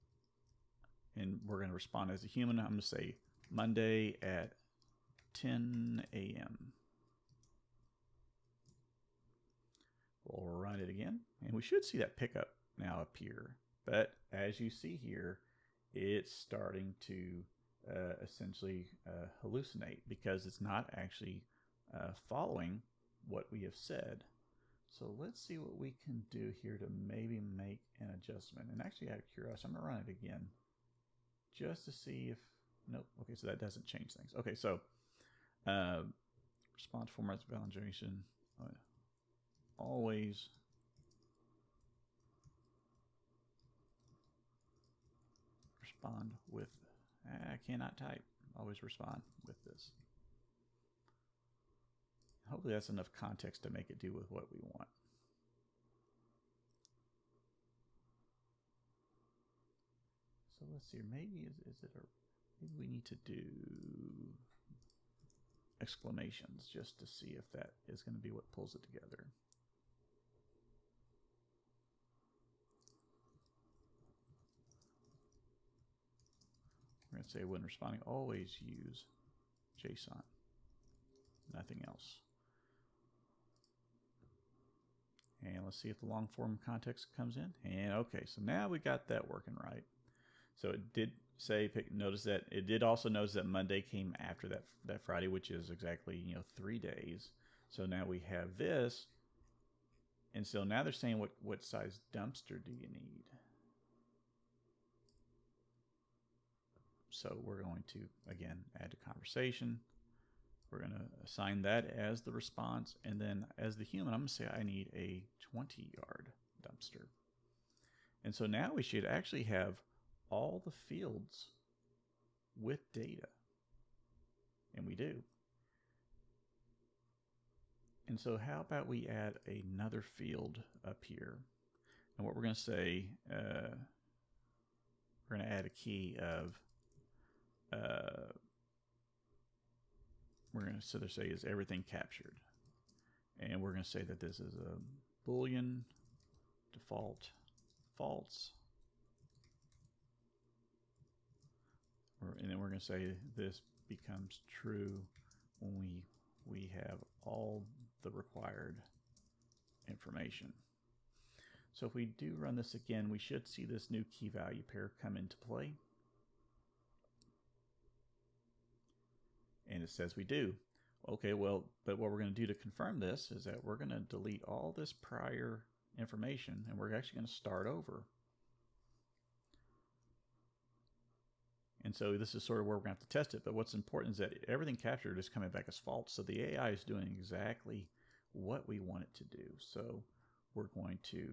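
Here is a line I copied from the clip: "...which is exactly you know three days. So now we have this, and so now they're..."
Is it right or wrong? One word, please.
right.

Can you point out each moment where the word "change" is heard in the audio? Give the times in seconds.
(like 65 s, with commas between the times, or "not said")
33 s.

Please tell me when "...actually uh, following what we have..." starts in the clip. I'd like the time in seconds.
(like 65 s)
20 s.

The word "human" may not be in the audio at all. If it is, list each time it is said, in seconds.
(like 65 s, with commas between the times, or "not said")
2 s, 113 s.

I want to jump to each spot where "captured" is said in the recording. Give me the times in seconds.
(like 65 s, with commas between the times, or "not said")
141 s, 184 s.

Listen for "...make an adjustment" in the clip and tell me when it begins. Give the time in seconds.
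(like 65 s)
27 s.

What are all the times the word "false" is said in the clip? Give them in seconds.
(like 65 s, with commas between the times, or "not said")
147 s, 185 s.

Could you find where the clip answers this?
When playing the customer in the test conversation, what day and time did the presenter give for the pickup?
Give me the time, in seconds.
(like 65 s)
3 s.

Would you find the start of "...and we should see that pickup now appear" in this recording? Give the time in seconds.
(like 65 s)
11 s.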